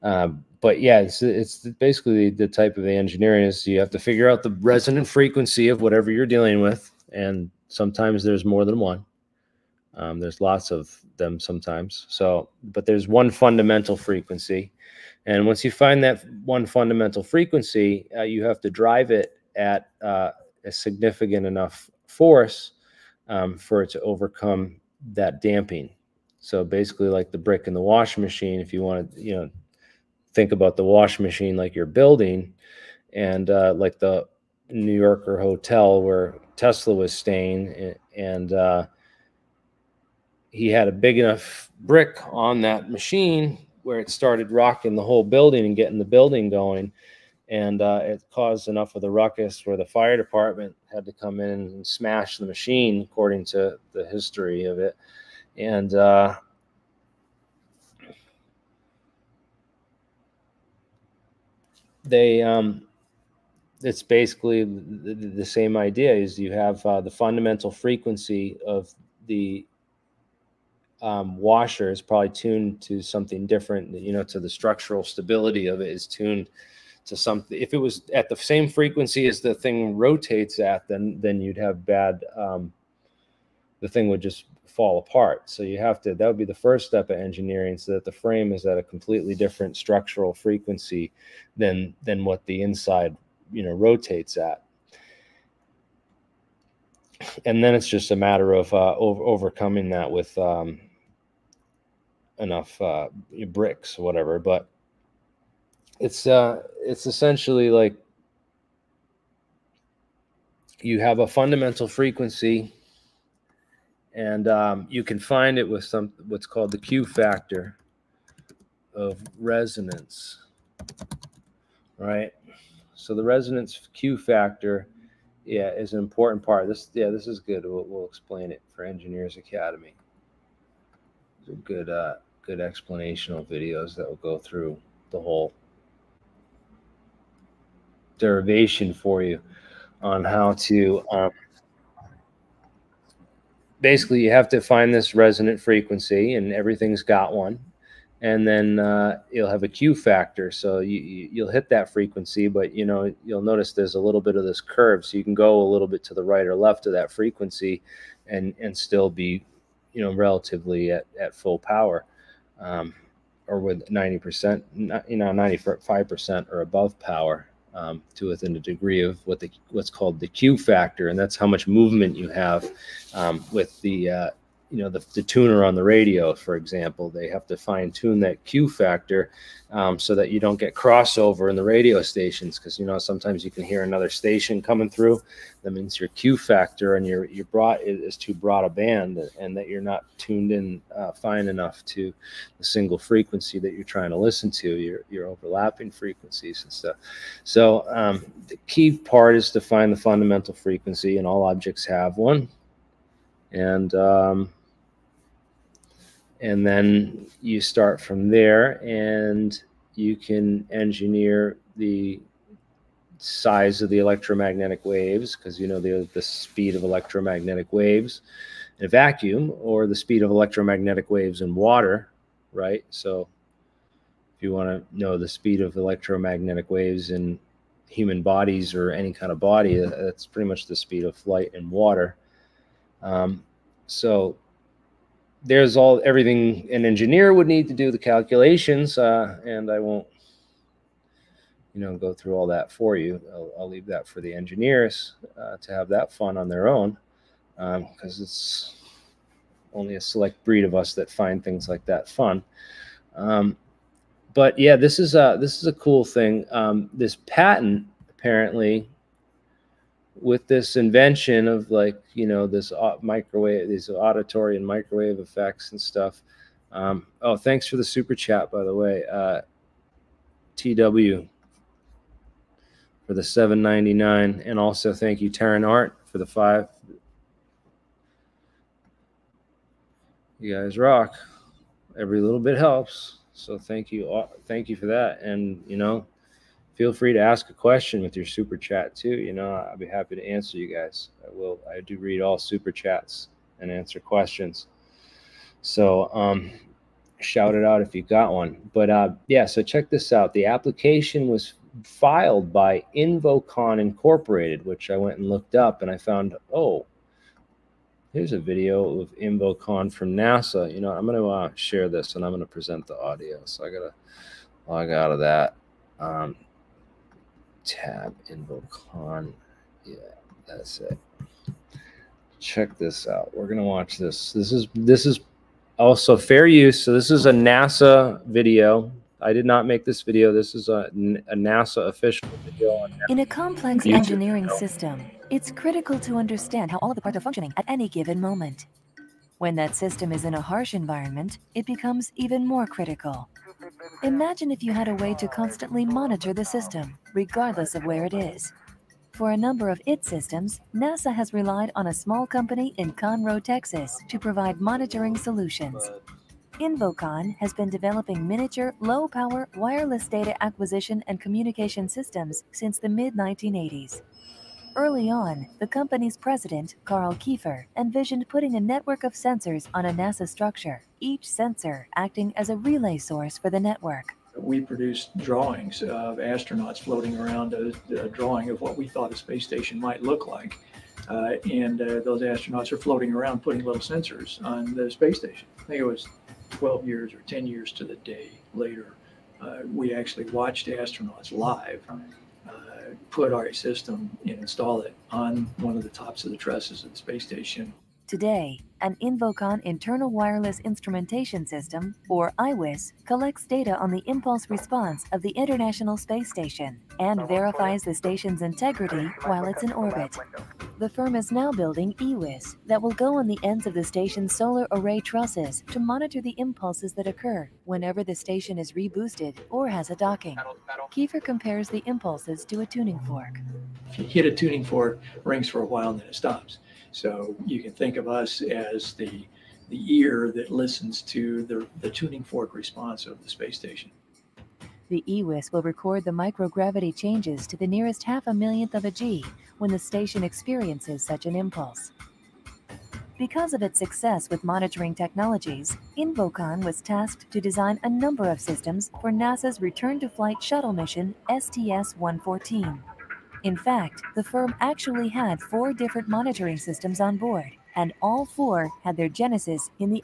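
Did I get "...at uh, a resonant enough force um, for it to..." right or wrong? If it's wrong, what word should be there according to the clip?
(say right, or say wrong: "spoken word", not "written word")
wrong: "significant", not "resonant".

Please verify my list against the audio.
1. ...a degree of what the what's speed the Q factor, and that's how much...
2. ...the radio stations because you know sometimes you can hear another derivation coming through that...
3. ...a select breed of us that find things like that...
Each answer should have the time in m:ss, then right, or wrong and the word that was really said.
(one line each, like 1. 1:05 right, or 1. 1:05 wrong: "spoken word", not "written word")
1. 2:48 wrong: "called", not "speed"
2. 3:01 wrong: "station", not "derivation"
3. 4:09 right.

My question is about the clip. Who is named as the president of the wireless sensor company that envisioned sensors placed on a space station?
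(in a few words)
Carl Kiefer.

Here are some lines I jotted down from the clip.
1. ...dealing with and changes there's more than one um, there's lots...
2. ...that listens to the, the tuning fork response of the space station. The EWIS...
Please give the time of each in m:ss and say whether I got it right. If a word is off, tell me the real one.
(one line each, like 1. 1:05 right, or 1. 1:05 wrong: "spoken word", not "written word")
1. 0:06 wrong: "sometimes", not "changes"
2. 7:10 right.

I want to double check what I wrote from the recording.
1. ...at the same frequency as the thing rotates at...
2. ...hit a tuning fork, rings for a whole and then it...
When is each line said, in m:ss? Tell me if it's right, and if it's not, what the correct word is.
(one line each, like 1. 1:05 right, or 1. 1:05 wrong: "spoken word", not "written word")
1. 1:18 right
2. 7:04 wrong: "while", not "whole".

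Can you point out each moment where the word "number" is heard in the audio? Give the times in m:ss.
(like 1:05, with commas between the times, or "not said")
5:49, 7:27.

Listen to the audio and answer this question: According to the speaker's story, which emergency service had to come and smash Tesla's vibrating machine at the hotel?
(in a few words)
fire department.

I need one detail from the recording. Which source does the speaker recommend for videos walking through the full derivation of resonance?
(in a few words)
Engineers Academy.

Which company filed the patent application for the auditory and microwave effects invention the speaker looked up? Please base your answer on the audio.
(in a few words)
Invocon Incorporated.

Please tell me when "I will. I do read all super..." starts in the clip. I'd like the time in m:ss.
4:51.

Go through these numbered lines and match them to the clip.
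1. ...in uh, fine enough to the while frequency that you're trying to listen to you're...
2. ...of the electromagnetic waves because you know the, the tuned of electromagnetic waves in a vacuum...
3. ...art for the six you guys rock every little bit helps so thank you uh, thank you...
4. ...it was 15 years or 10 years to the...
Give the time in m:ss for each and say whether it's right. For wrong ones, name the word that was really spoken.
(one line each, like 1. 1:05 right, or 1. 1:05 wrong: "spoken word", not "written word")
1. 3:10 wrong: "single", not "while"
2. 3:33 wrong: "speed", not "tuned"
3. 4:35 wrong: "five", not "six"
4. 6:25 wrong: "12", not "15".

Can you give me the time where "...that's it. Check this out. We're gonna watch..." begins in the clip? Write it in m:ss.
5:20.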